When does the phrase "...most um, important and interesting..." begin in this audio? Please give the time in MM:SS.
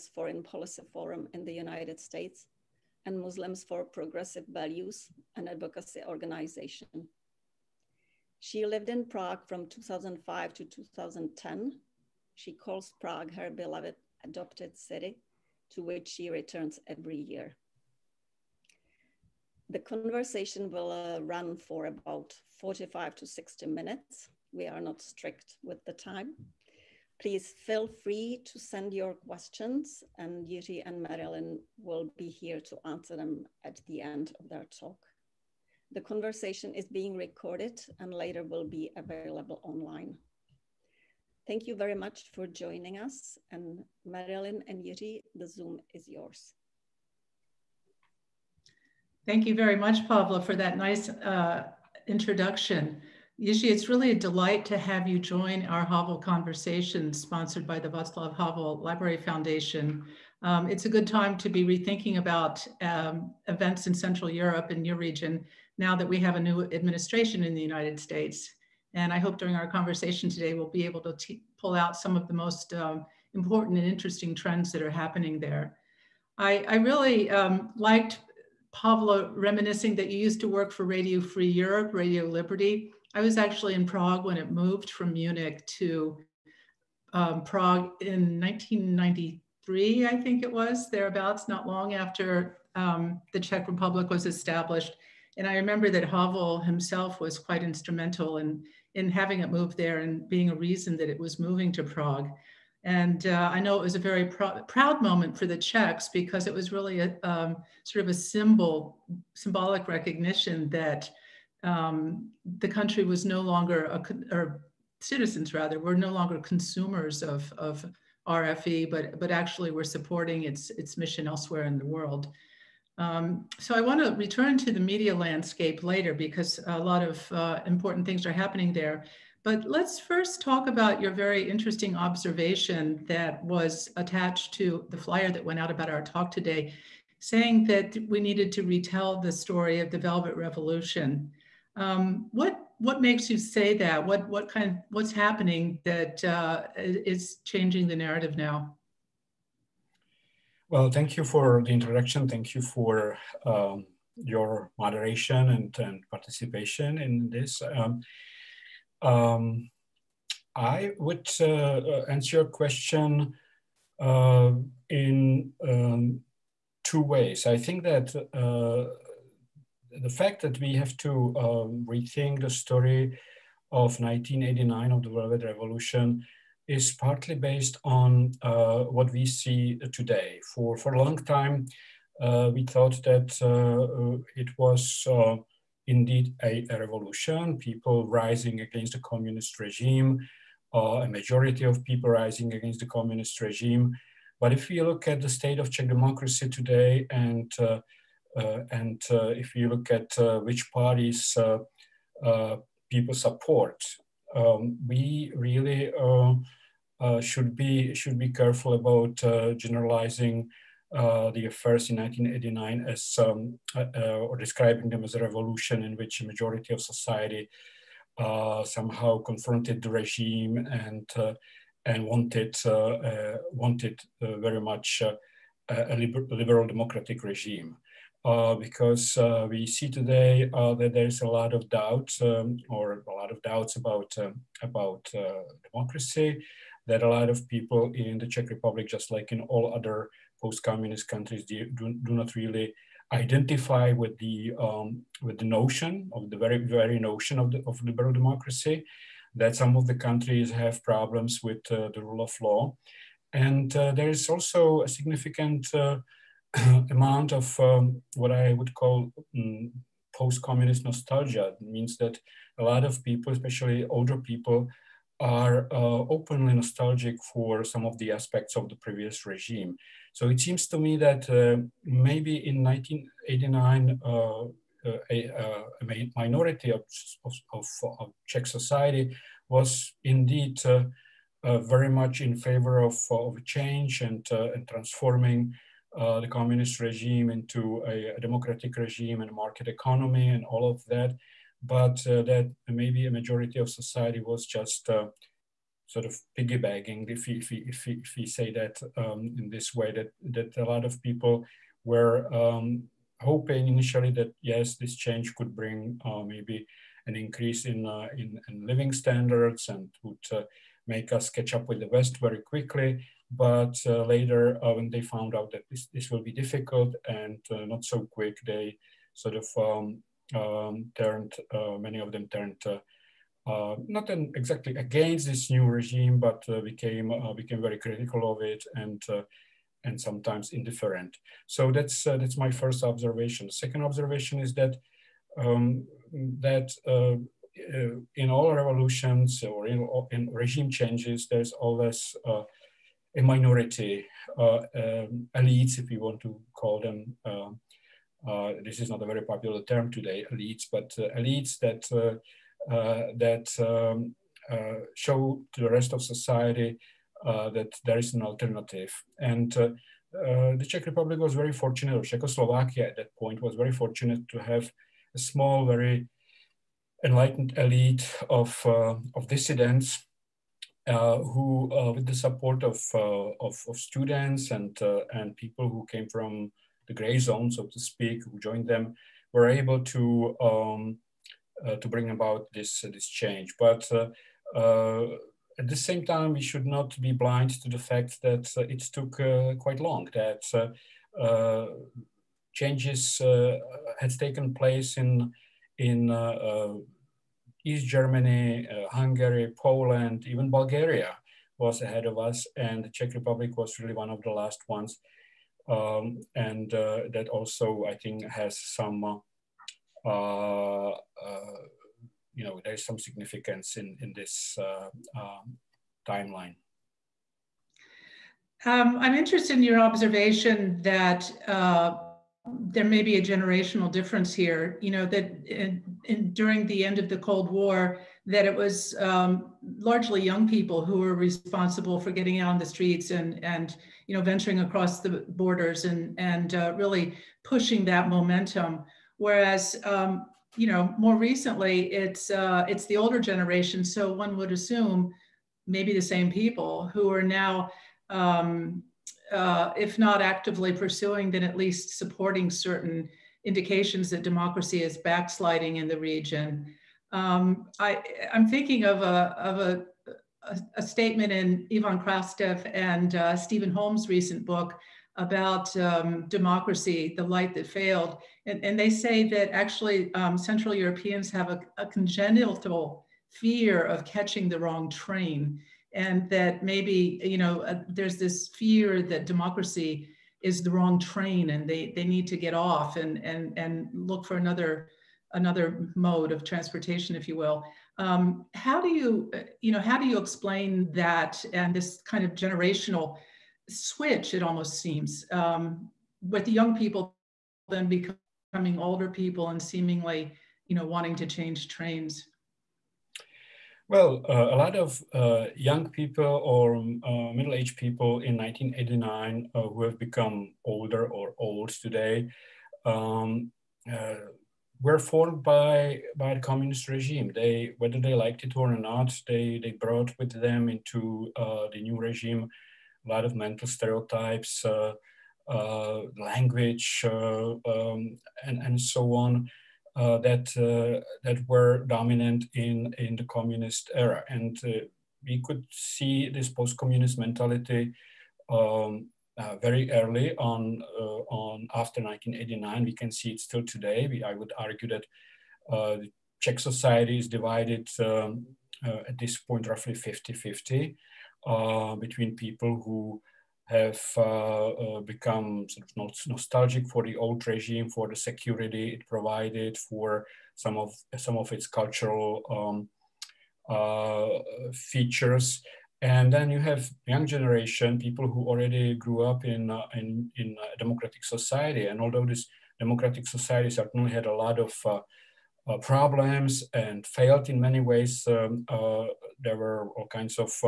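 01:12.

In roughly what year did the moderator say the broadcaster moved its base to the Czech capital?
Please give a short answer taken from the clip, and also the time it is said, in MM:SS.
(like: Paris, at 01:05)
1993, at 01:28.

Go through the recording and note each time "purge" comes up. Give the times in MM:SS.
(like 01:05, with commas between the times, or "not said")
not said.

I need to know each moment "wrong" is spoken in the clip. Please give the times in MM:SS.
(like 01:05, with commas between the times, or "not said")
07:54, 08:00.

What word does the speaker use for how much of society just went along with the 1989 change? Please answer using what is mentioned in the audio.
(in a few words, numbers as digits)
piggybacking.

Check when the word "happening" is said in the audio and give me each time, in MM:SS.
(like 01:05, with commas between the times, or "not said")
01:14, 02:08, 02:25.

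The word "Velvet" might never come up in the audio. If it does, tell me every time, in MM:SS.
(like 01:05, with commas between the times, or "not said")
02:19, 02:55.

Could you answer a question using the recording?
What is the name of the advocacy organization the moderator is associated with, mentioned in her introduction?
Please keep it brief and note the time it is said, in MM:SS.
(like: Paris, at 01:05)
Muslims for Progressive Values, at 00:03.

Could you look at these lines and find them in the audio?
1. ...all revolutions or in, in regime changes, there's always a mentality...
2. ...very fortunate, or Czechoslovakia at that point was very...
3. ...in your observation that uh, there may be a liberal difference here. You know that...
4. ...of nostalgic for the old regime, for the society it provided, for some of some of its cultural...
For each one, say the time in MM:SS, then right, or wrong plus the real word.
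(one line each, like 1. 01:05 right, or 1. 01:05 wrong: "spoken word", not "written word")
1. 05:38 wrong: "minority", not "mentality"
2. 06:01 right
3. 06:59 wrong: "generational", not "liberal"
4. 09:16 wrong: "security", not "society".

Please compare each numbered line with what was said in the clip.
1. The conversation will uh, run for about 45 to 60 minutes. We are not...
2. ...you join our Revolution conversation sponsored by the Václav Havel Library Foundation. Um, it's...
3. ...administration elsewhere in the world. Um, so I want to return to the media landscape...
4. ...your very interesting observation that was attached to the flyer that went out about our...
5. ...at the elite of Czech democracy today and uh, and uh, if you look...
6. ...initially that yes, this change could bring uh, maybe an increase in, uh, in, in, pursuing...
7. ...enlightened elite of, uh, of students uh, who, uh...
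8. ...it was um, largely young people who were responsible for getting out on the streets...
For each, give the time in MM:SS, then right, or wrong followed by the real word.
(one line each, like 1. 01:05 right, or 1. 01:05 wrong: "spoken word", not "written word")
1. 00:19 right
2. 00:55 wrong: "Havel", not "Revolution"
3. 02:00 wrong: "mission", not "administration"
4. 02:11 right
5. 03:15 wrong: "state", not "elite"
6. 05:03 wrong: "living", not "pursuing"
7. 06:07 wrong: "dissidents", not "students"
8. 07:08 right.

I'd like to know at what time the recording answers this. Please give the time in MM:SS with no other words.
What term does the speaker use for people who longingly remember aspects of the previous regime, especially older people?
04:20.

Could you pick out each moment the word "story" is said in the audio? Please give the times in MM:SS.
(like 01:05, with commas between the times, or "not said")
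02:19, 02:52.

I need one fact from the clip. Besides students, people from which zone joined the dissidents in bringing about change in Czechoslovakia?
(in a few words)
the gray zone.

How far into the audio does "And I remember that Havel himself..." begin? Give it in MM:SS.
01:35.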